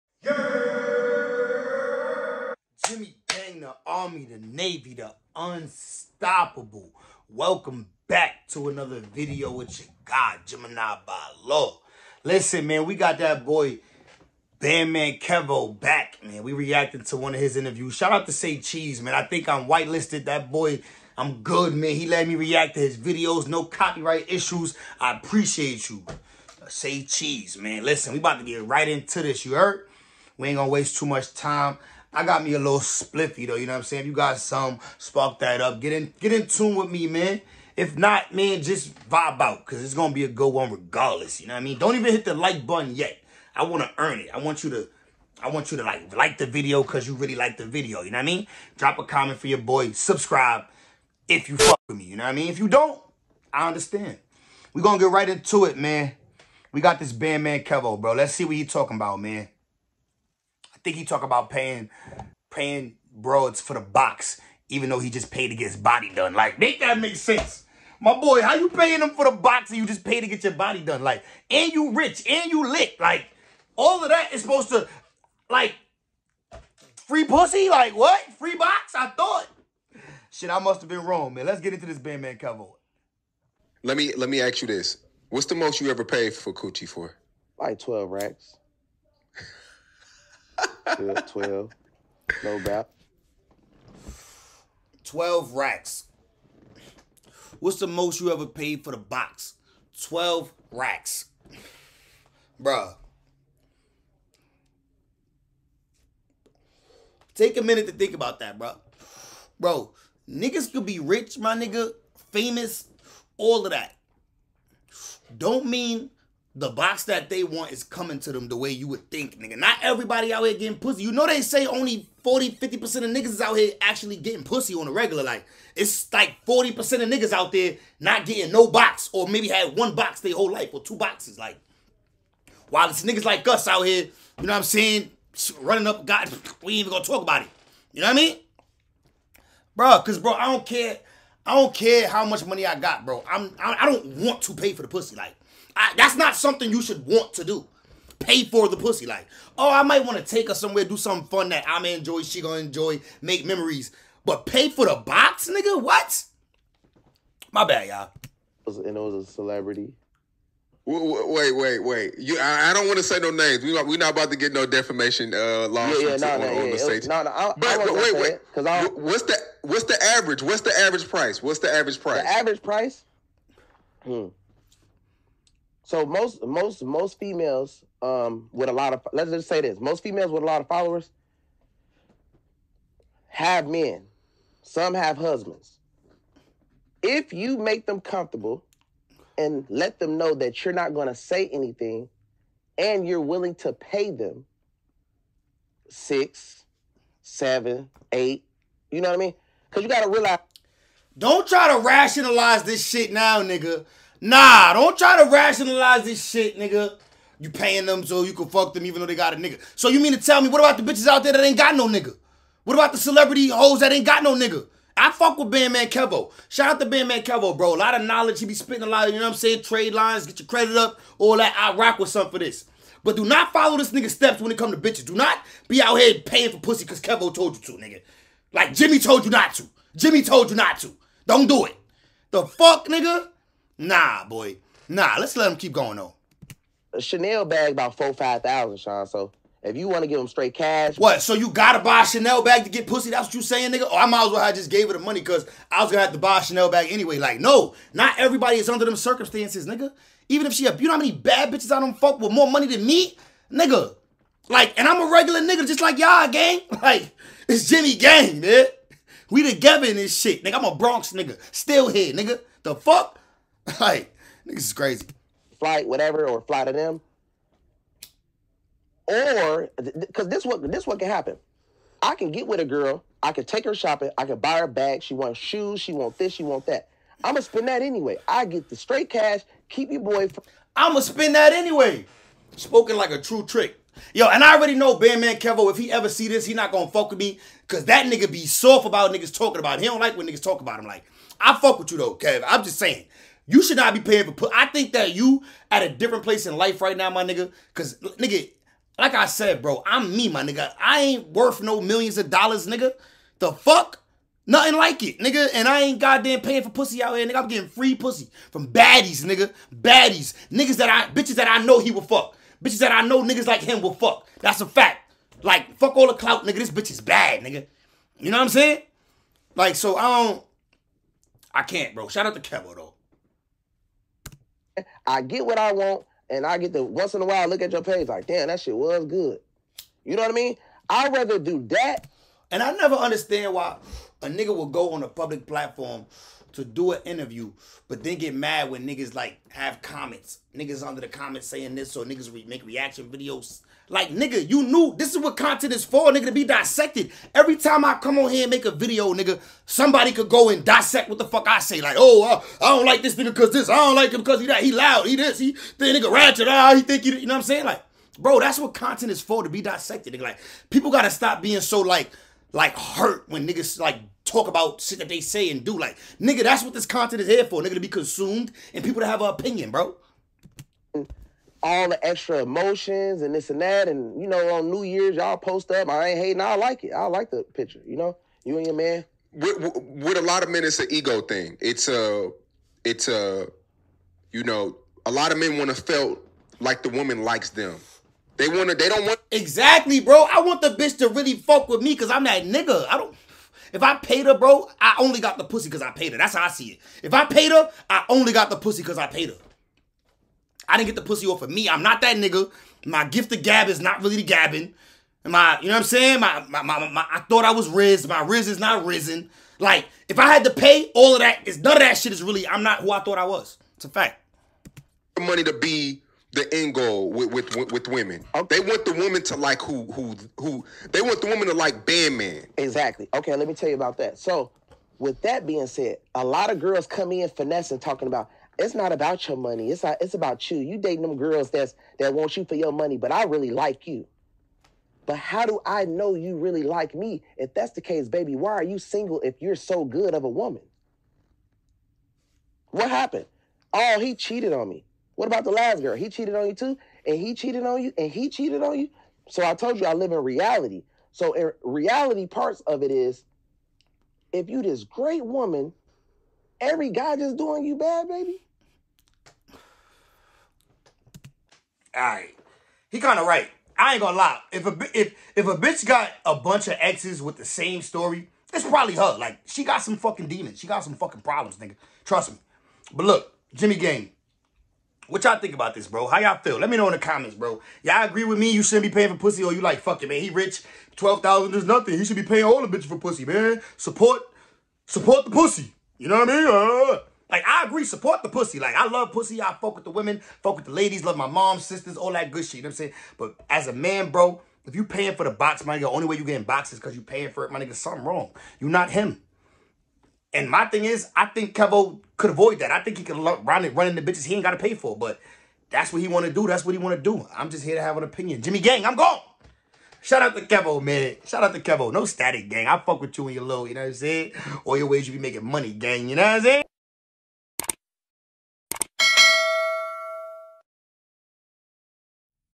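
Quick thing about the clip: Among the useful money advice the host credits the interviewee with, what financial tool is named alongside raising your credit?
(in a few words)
Trade lines.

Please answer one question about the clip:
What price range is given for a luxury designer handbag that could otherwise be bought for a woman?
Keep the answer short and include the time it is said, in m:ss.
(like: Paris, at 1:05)
4-5 thousand, at 3:57.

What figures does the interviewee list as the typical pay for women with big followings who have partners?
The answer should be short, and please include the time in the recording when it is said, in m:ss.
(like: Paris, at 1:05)
6, 7, 8, at 3:15.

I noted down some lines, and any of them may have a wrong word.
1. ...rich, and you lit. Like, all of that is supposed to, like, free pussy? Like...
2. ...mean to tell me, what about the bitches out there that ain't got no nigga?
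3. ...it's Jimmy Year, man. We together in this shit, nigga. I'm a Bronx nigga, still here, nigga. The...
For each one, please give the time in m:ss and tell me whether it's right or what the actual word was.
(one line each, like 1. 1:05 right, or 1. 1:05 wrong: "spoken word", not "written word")
1. 1:11 right
2. 3:29 right
3. 4:17 wrong: "Gang", not "Year".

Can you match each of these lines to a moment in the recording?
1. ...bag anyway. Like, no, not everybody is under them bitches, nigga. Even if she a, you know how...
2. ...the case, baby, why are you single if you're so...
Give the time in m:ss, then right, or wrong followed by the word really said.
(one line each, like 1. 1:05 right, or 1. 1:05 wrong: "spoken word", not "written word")
1. 4:06 wrong: "circumstances", not "bitches"
2. 7:17 right.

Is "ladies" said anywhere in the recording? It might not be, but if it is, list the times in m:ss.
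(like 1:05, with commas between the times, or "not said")
8:10.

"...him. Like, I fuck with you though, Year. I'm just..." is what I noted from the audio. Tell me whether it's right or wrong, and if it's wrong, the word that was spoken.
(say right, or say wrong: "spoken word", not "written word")
wrong: "Kev", not "Year".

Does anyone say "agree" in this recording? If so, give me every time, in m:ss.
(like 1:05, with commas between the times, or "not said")
7:58, 8:07.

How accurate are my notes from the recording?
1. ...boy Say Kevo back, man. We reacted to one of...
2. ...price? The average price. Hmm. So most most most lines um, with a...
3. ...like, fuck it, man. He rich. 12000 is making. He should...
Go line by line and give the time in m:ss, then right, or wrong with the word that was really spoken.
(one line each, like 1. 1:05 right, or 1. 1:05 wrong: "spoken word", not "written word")
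1. 0:13 wrong: "Bandman", not "Say"
2. 2:52 wrong: "females", not "lines"
3. 7:59 wrong: "nothing", not "making".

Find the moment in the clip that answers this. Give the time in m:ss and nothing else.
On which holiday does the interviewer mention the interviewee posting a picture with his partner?
6:14.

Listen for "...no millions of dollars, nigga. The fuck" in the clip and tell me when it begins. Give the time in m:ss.
5:01.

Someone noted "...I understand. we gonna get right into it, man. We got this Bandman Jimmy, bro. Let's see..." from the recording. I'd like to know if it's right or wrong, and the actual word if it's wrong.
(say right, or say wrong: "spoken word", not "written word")
wrong: "Kevo", not "Jimmy".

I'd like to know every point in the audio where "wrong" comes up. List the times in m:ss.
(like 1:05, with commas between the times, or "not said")
1:21, 8:18.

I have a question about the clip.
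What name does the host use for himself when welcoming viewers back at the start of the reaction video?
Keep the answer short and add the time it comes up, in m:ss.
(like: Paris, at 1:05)
Gemini by Law, at 0:10.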